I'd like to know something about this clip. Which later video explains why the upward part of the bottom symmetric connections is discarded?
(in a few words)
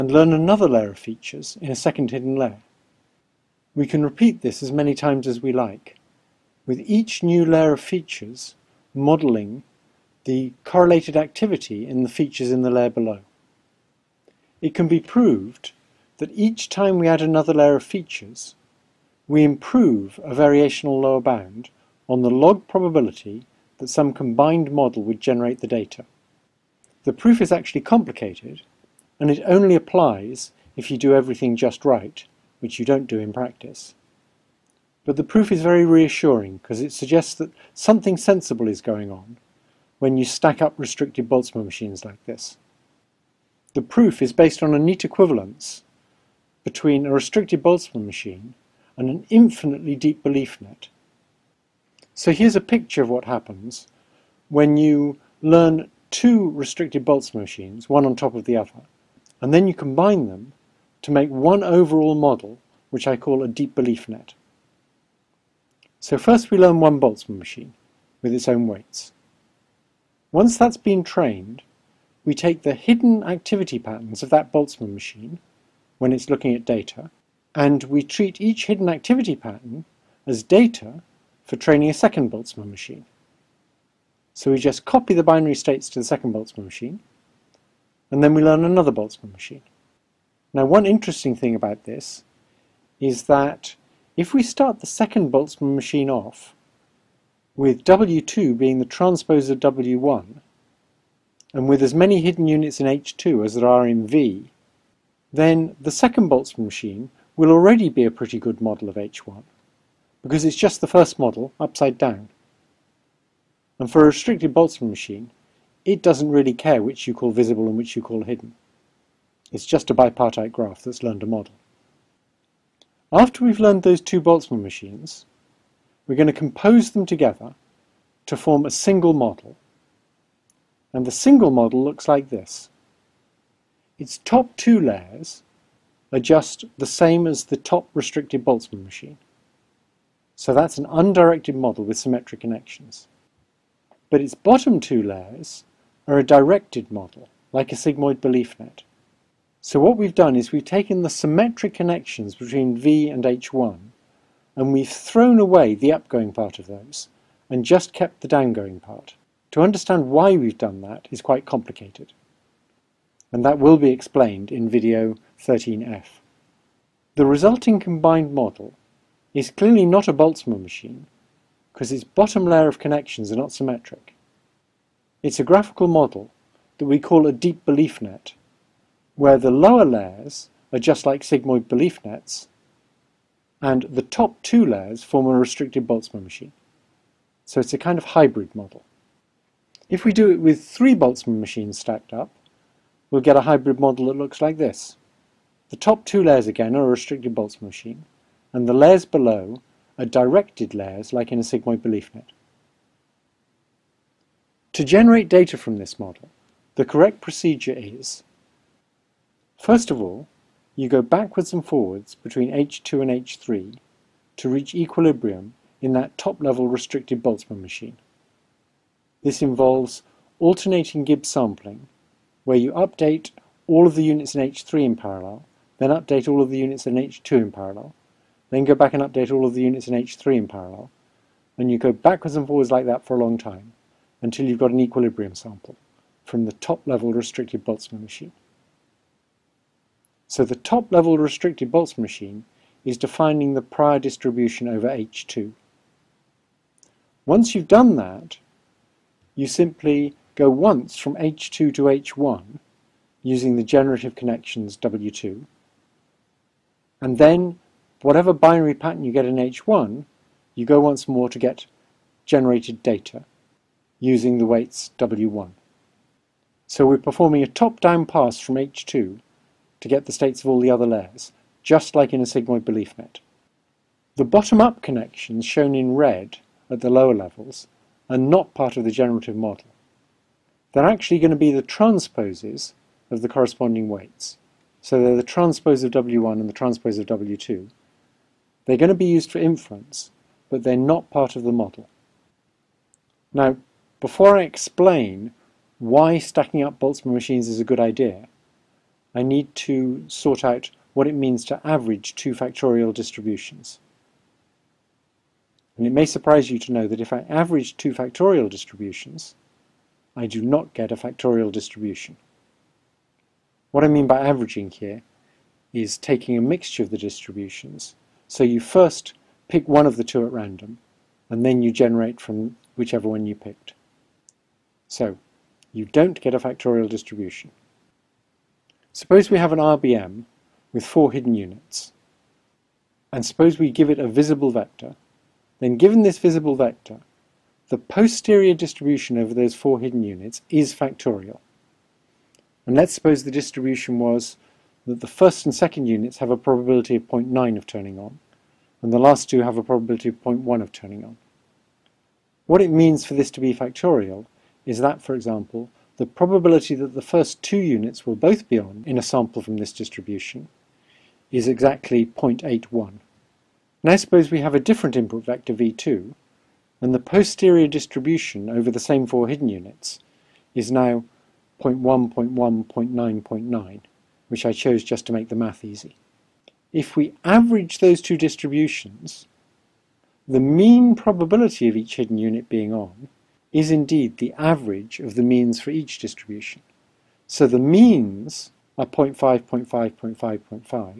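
13F.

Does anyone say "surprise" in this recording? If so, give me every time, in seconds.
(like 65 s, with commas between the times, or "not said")
306 s.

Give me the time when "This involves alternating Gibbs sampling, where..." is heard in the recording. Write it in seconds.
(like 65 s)
219 s.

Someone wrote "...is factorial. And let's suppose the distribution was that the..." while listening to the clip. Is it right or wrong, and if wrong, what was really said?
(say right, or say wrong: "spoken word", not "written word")
right.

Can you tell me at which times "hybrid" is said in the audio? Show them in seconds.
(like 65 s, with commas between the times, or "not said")
188 s, 193 s.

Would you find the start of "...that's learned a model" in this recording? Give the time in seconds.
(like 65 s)
120 s.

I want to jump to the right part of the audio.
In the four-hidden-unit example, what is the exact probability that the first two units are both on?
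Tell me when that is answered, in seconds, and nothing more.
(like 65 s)
362 s.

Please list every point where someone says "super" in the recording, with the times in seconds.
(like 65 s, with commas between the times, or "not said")
not said.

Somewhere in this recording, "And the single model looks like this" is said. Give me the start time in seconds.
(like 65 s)
130 s.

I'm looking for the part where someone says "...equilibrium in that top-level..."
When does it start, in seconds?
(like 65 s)
214 s.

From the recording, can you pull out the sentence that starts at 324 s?
So you don't get a factorial distribution.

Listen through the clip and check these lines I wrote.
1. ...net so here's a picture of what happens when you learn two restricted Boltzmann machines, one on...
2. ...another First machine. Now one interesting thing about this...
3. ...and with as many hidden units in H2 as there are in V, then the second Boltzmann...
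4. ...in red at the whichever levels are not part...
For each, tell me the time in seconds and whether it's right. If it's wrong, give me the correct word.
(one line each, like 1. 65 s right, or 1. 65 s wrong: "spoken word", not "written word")
1. 50 s right
2. 88 s wrong: "Boltzmann", not "First"
3. 101 s right
4. 275 s wrong: "lower", not "whichever".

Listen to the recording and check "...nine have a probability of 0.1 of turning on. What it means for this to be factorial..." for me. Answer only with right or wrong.
wrong.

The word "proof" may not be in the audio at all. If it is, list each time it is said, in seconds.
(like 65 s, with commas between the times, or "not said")
27 s, 35 s, 43 s.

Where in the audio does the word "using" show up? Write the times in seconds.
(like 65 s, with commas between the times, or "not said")
253 s, 263 s.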